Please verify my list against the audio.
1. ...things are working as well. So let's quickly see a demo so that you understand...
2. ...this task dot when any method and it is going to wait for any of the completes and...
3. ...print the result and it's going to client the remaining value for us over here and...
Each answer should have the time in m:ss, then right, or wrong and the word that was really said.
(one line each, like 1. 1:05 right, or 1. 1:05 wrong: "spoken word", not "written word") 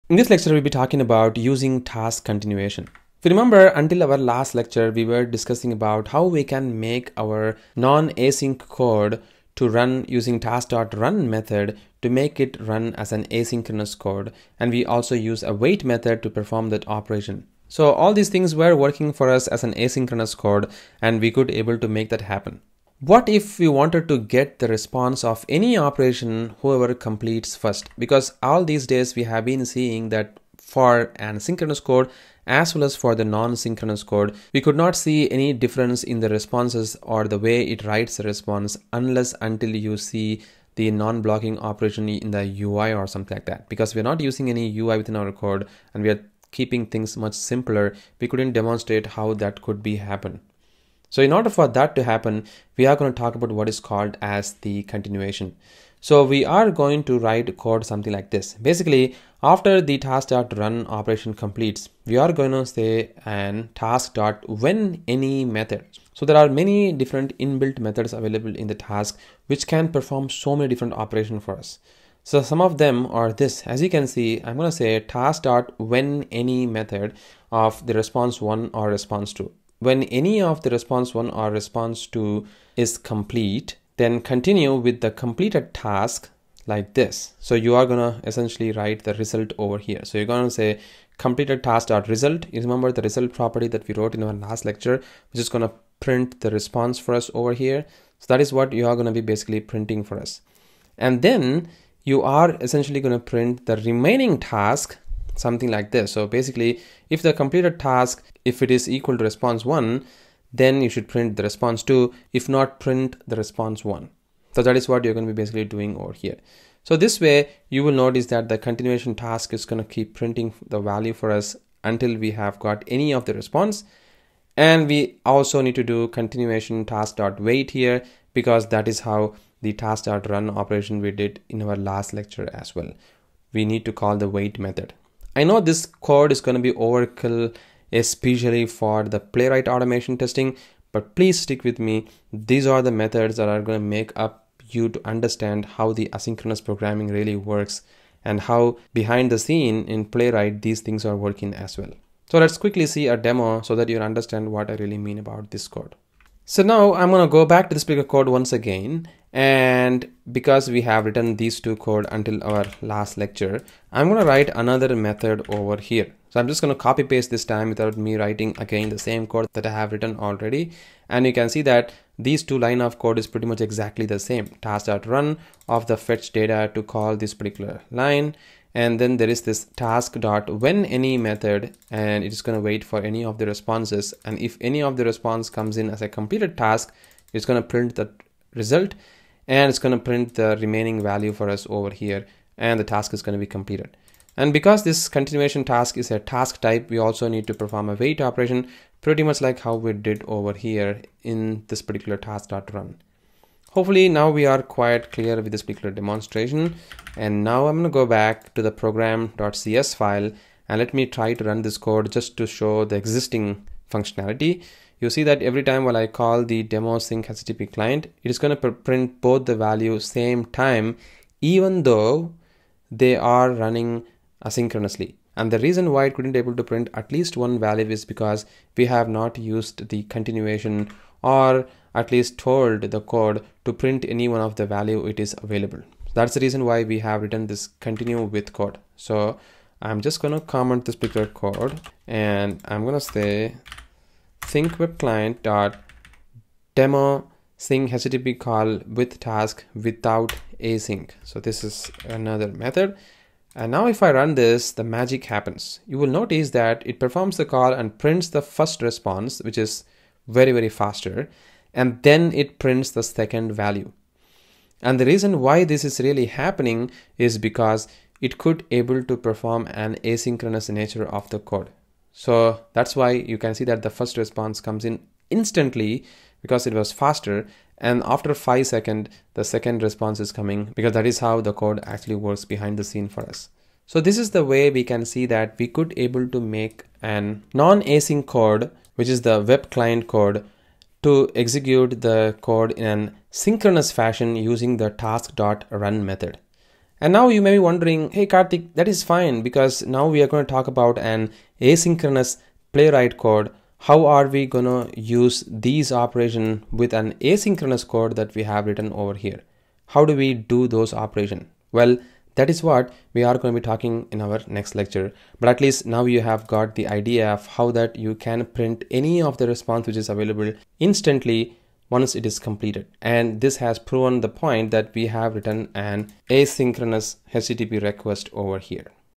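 1. 2:30 right
2. 2:59 wrong: "responses", not "completes"
3. 3:07 wrong: "print", not "client".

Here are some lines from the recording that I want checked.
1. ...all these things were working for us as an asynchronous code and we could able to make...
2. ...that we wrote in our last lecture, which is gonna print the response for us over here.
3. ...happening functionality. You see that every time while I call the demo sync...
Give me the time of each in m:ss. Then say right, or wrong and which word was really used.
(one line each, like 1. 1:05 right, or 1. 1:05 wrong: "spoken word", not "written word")
1. 0:17 right
2. 1:33 right
3. 3:32 wrong: "existing", not "happening".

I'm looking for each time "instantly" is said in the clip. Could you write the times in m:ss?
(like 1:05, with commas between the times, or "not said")
4:35, 5:20.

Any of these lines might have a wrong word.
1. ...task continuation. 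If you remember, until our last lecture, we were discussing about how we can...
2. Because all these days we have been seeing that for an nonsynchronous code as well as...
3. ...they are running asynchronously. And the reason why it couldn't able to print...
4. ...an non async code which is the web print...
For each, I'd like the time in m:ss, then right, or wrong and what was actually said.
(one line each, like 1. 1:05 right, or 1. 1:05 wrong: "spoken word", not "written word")
1. 0:01 right
2. 0:27 wrong: "synchronous", not "nonsynchronous"
3. 3:42 right
4. 4:47 wrong: "client", not "print".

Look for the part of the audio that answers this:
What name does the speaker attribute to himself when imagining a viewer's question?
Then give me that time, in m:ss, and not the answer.
4:58.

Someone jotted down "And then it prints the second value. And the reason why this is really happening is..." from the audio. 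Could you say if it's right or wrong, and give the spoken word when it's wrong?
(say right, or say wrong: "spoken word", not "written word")
right.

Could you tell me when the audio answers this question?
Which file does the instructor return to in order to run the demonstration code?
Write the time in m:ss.
3:28.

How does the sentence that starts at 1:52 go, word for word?
If not, print the response 1.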